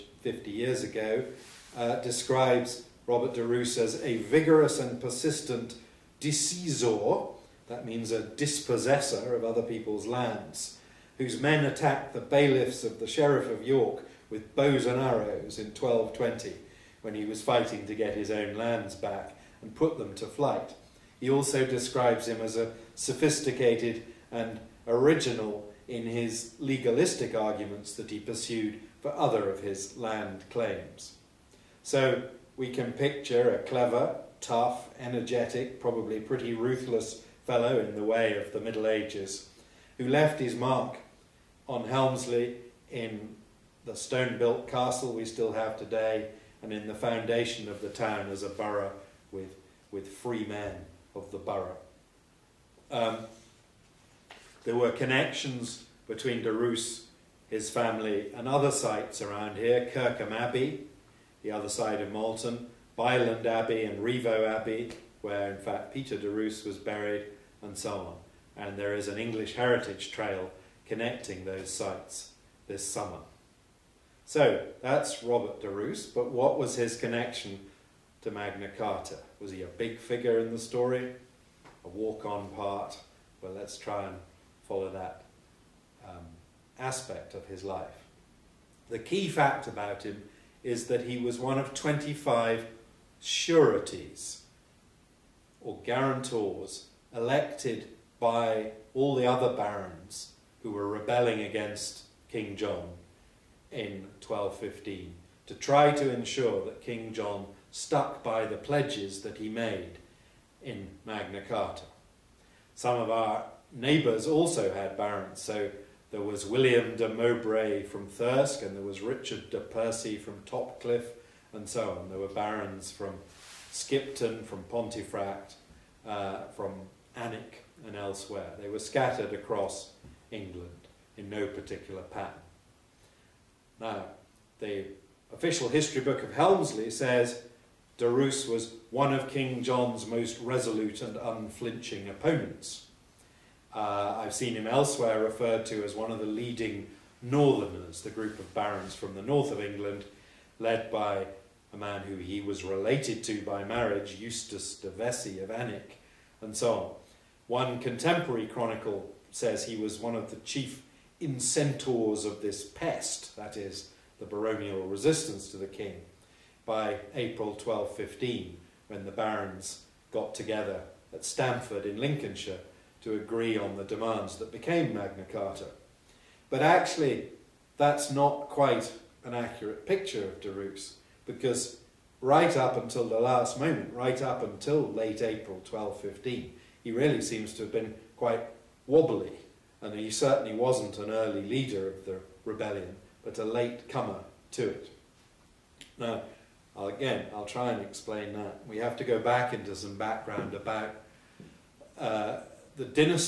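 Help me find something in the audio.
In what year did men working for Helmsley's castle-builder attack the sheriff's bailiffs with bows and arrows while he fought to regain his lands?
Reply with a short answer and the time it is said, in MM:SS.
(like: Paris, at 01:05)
1220, at 00:15.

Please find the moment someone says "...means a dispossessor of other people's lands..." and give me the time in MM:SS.
00:07.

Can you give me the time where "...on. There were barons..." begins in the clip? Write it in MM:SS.
02:02.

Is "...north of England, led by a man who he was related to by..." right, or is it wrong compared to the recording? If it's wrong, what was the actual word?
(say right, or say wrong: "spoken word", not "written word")
right.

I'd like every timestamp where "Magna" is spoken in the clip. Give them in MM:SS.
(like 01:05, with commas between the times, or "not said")
01:18, 01:51, 02:54.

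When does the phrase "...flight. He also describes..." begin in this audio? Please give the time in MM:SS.
00:20.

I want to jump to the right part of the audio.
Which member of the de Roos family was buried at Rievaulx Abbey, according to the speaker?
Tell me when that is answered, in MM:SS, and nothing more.
01:05.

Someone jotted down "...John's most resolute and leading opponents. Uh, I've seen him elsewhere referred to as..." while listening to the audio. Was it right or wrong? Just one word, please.
wrong.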